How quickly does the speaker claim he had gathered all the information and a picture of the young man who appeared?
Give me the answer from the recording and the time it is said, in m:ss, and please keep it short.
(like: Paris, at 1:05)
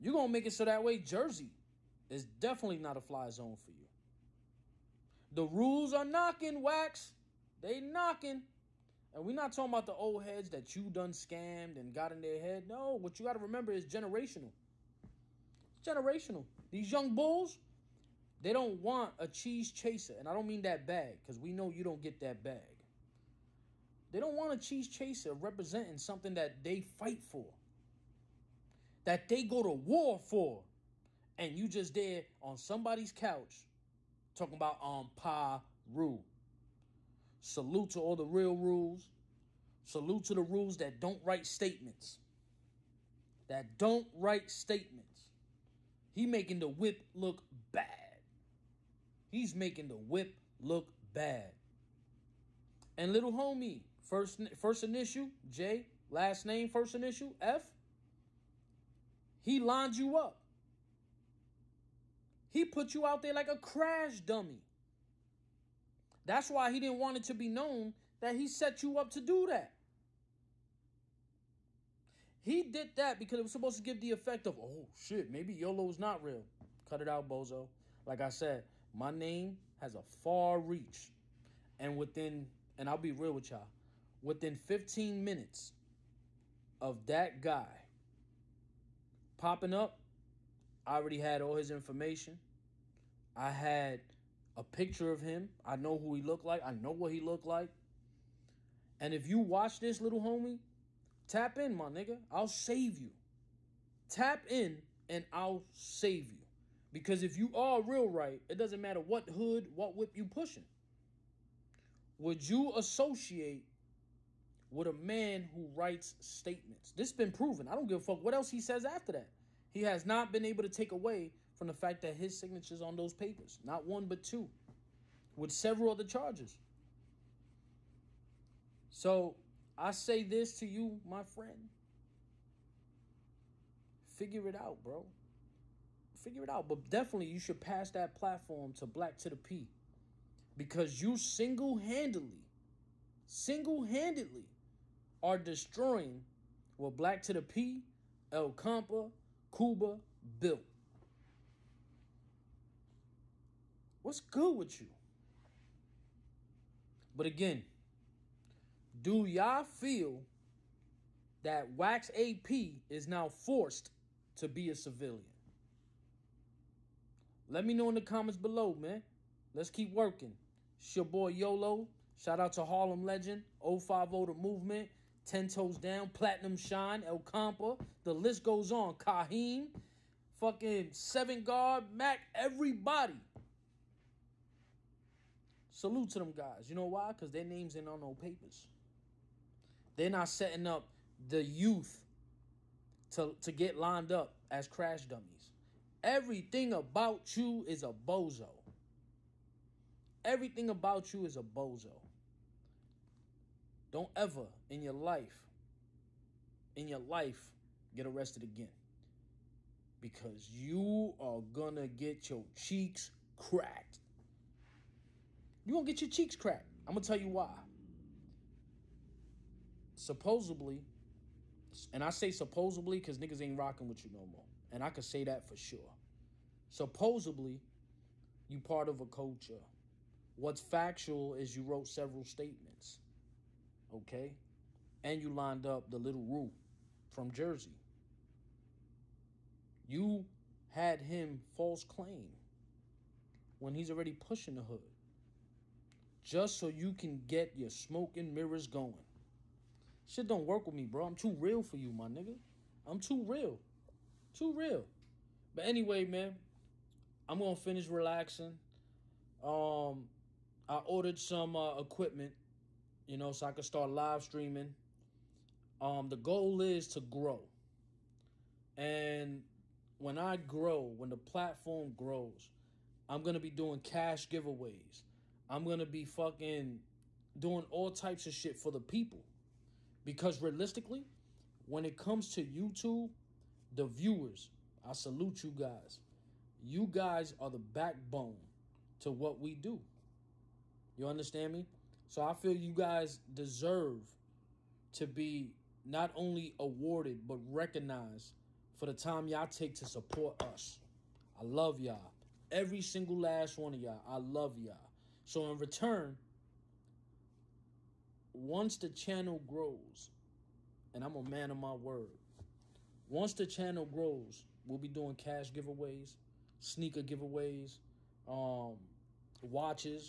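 15 minutes, at 1:24.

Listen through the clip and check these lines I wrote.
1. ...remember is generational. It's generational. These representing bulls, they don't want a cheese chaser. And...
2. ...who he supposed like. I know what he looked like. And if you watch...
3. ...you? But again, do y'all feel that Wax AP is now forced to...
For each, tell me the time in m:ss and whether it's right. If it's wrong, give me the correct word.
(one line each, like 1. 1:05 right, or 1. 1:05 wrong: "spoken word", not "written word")
1. 0:13 wrong: "young", not "representing"
2. 1:35 wrong: "looked", not "supposed"
3. 2:34 right.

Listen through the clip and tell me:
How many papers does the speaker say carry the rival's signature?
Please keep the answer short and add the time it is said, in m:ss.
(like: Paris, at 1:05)
2, at 2:04.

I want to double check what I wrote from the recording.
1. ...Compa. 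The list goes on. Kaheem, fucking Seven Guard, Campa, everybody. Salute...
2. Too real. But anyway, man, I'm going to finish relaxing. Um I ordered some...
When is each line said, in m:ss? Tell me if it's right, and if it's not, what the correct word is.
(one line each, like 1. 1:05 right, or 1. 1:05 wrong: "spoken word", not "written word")
1. 2:57 wrong: "Mac", not "Campa"
2. 4:14 right.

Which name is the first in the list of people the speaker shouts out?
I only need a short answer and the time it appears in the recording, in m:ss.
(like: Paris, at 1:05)
Harlem Legend, at 2:52.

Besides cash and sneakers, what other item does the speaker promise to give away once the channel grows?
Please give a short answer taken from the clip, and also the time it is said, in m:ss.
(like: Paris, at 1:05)
watches, at 5:19.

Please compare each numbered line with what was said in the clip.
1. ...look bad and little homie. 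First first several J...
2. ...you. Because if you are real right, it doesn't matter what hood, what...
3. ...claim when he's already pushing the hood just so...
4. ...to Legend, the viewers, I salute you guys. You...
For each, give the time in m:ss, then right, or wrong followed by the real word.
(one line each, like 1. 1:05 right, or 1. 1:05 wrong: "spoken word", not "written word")
1. 0:50 wrong: "initial", not "several"
2. 1:46 right
3. 4:01 right
4. 4:42 wrong: "YouTube", not "Legend".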